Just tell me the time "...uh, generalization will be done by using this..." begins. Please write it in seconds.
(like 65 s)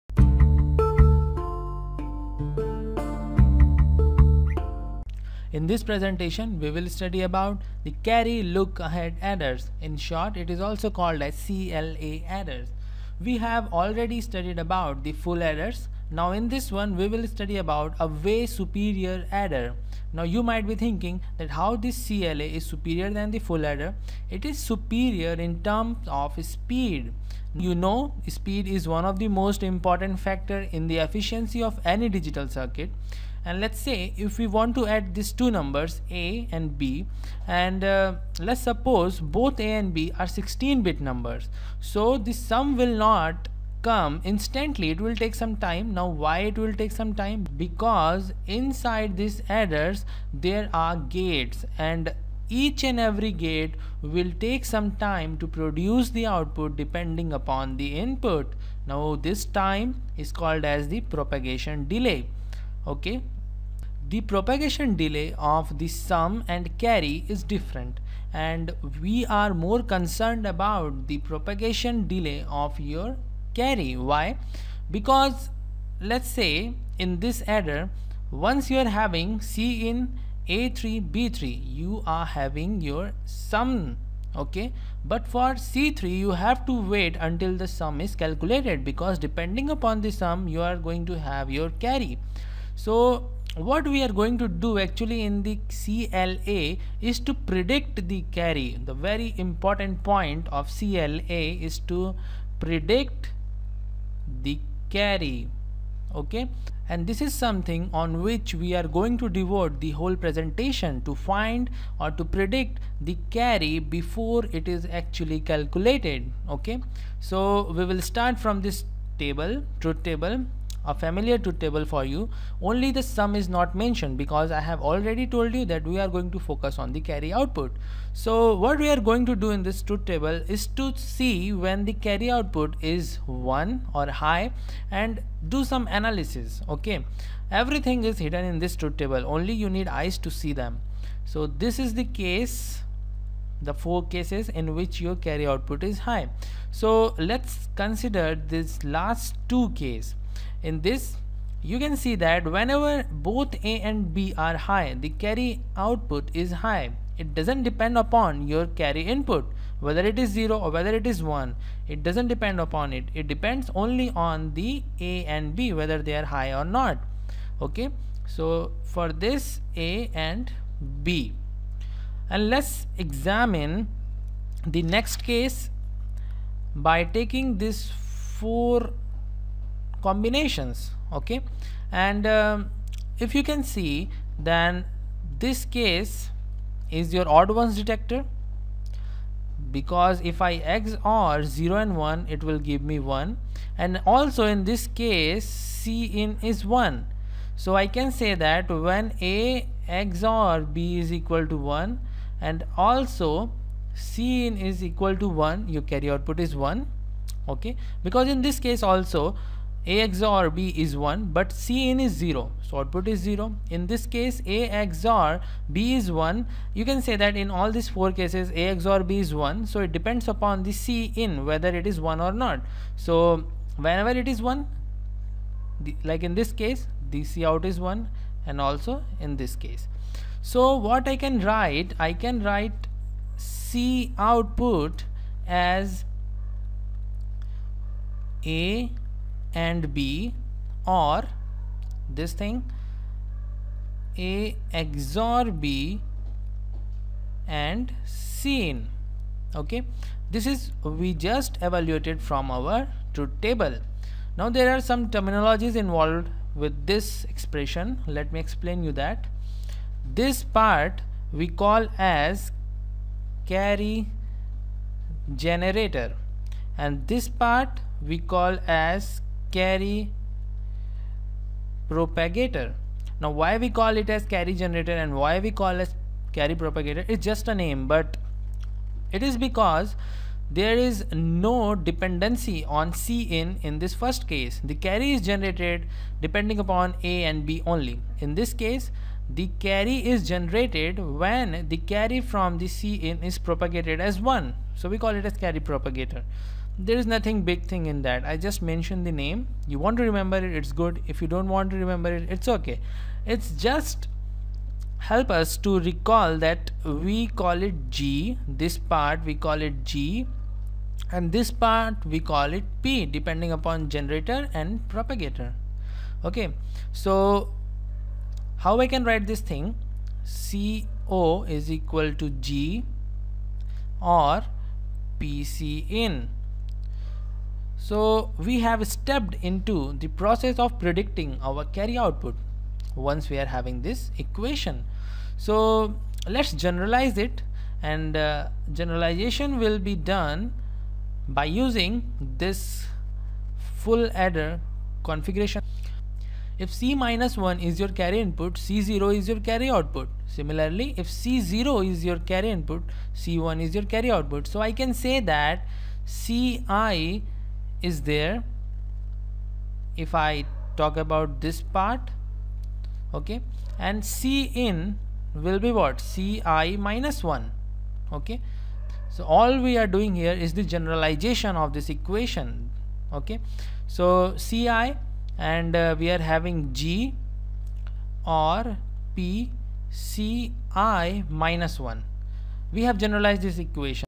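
338 s.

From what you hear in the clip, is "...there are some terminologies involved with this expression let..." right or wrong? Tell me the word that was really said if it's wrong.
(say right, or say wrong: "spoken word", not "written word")
right.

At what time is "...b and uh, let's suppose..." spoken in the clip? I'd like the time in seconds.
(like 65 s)
36 s.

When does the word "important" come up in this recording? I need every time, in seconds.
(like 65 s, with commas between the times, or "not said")
29 s, 99 s.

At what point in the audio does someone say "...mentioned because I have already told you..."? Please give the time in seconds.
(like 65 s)
123 s.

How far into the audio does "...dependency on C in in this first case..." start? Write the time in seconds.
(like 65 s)
281 s.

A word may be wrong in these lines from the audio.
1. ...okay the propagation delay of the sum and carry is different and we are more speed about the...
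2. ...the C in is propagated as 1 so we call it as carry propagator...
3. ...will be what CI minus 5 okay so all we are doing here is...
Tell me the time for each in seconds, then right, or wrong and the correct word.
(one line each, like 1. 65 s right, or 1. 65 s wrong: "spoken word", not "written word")
1. 62 s wrong: "concerned", not "speed"
2. 292 s right
3. 365 s wrong: "1", not "5".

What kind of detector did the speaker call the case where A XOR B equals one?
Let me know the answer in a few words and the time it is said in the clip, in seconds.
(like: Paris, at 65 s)
odd ones detector, at 187 s.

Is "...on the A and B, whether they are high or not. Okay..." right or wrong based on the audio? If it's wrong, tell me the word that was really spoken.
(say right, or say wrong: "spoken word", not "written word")
right.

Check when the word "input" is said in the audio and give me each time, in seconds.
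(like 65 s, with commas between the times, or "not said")
57 s, 159 s, 348 s, 352 s.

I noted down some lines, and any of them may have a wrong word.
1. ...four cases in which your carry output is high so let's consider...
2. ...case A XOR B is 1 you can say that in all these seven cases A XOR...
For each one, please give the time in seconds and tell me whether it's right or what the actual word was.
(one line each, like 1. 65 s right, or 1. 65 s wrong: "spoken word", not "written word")
1. 143 s right
2. 214 s wrong: "four", not "seven".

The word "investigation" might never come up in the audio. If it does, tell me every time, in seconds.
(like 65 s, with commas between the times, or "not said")
not said.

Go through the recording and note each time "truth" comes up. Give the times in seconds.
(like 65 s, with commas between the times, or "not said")
119 s, 129 s, 138 s, 253 s.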